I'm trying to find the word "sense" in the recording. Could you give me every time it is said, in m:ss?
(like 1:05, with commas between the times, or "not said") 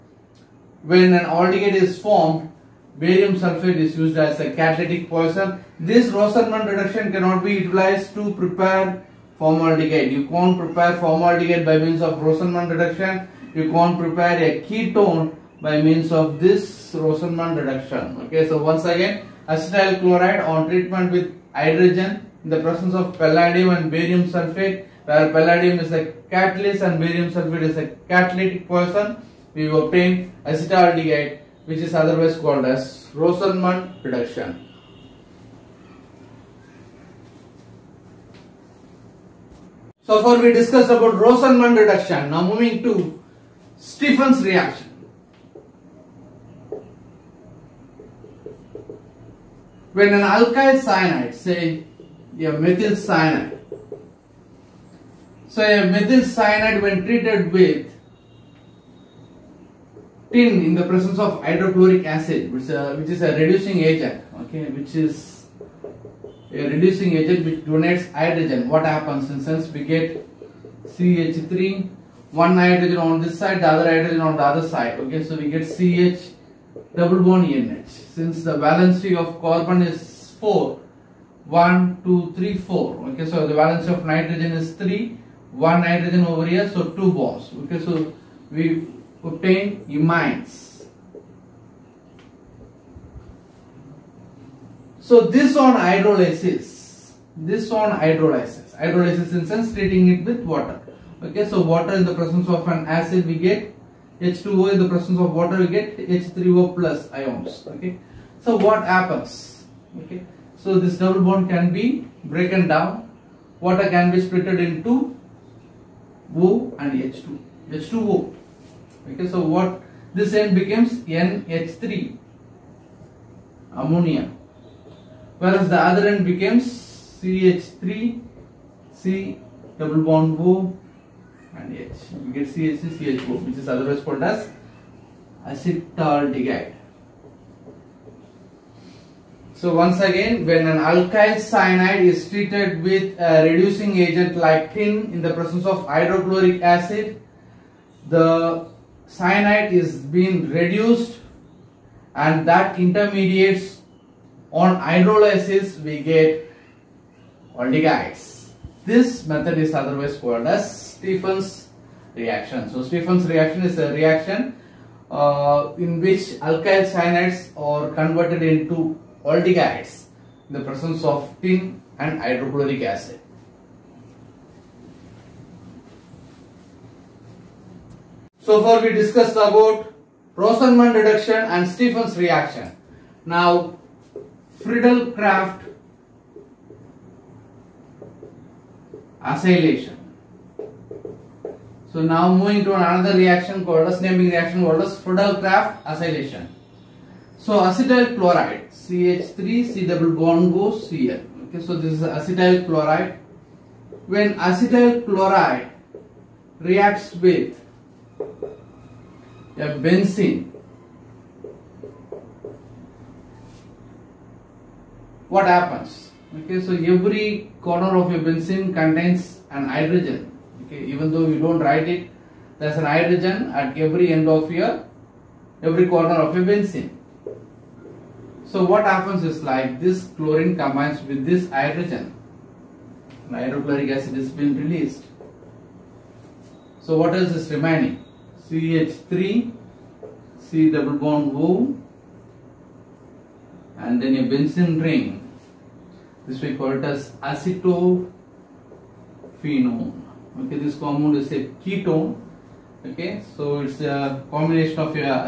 1:09, 1:39.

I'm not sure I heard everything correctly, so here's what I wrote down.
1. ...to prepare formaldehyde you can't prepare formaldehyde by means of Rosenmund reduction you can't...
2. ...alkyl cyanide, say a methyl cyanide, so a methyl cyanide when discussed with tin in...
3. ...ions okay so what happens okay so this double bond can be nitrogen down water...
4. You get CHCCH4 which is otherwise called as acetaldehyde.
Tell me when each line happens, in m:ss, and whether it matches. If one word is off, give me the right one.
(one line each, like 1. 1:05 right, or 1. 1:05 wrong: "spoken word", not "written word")
1. 0:08 right
2. 0:50 wrong: "treated", not "discussed"
3. 1:47 wrong: "broken", not "nitrogen"
4. 2:12 right.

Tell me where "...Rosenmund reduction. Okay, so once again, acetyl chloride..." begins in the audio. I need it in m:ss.
0:16.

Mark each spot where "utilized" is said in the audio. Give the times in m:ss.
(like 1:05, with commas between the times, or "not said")
0:07.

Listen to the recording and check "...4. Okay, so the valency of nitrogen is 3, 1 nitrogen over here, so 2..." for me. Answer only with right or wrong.
right.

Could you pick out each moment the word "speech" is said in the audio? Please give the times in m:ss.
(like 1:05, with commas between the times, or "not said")
not said.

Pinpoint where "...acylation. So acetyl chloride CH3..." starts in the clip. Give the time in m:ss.
3:15.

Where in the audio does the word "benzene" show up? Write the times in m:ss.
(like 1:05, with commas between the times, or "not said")
3:29, 3:38, 3:46, 4:04.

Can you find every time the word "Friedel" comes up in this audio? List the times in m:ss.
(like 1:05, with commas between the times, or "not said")
3:04, 3:14.